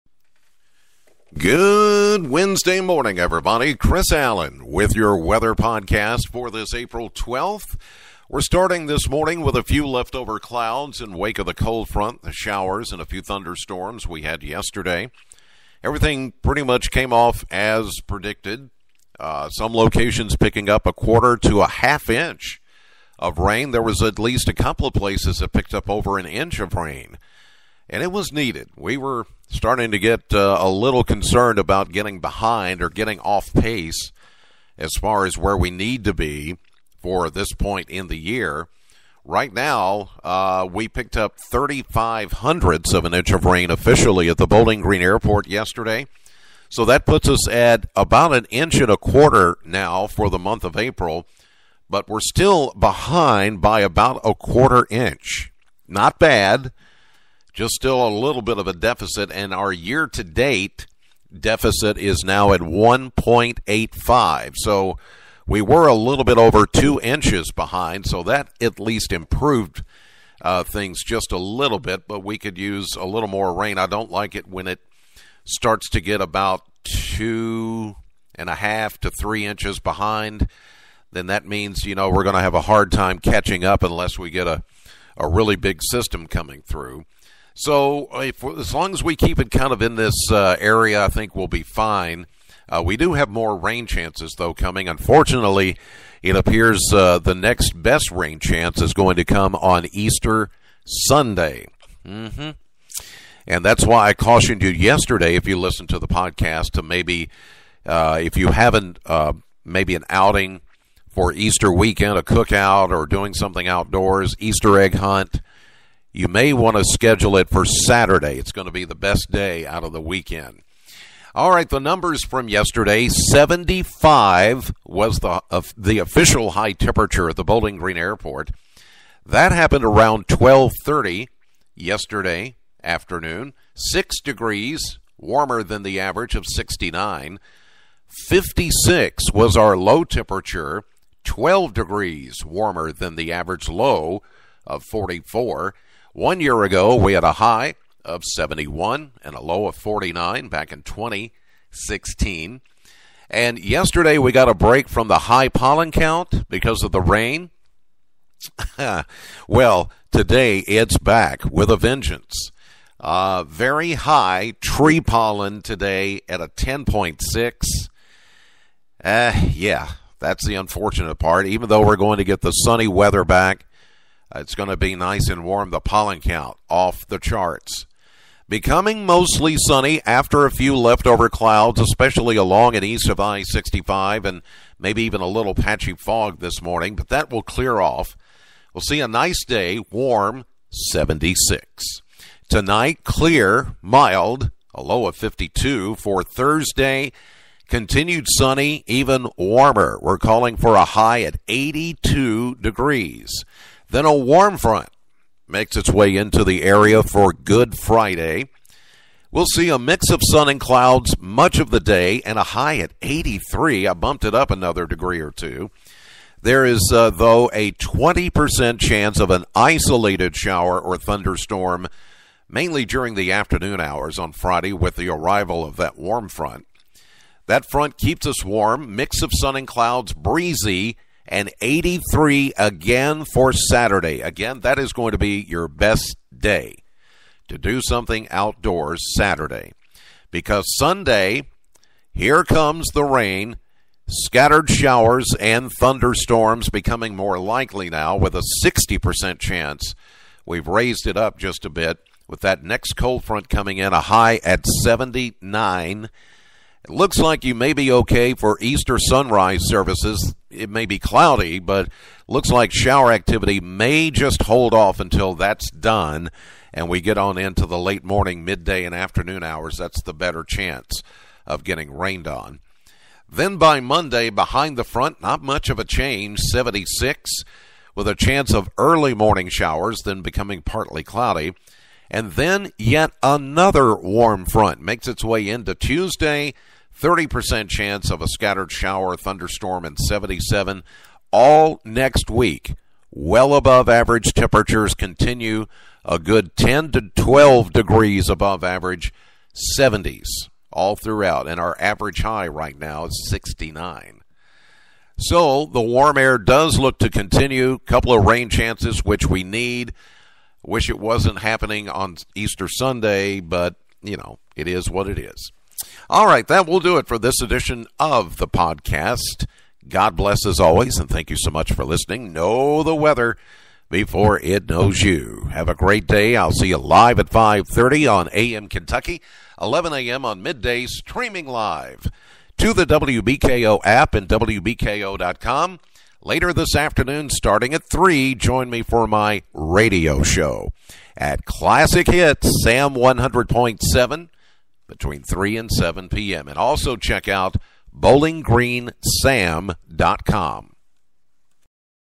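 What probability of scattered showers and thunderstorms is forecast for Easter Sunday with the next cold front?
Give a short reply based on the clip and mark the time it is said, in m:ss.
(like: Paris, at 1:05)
60%, at 4:08.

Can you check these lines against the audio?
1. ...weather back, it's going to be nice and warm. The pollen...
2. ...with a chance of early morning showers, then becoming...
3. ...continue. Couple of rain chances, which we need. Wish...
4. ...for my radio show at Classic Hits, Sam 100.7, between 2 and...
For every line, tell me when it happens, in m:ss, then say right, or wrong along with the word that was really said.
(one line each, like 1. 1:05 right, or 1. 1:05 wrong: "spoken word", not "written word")
1. 2:52 right
2. 4:37 right
3. 5:07 right
4. 5:38 wrong: "3", not "2".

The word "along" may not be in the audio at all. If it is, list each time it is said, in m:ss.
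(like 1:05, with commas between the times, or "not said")
3:02.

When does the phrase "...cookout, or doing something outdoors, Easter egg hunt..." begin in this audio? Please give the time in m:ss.
1:52.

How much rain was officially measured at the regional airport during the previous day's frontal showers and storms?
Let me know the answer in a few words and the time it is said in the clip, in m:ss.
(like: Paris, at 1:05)
0.35 inches, at 0:41.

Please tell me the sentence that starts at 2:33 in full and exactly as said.
And yesterday, we got a break from the high pollen count because of the rain.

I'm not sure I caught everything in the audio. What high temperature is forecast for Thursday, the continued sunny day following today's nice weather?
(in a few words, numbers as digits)
82 degrees.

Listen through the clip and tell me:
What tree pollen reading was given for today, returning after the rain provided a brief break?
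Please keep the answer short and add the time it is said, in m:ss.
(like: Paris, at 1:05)
10.6, at 2:46.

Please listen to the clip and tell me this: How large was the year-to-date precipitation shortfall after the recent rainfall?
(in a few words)
1.85.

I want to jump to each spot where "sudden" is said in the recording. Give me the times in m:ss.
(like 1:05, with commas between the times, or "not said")
not said.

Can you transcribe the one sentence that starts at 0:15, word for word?
Everything pretty much came off as predicted.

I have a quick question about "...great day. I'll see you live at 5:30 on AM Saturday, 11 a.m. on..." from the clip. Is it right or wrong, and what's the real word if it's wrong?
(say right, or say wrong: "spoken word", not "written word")
wrong: "Kentucky", not "Saturday".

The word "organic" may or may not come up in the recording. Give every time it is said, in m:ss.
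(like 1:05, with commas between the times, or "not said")
not said.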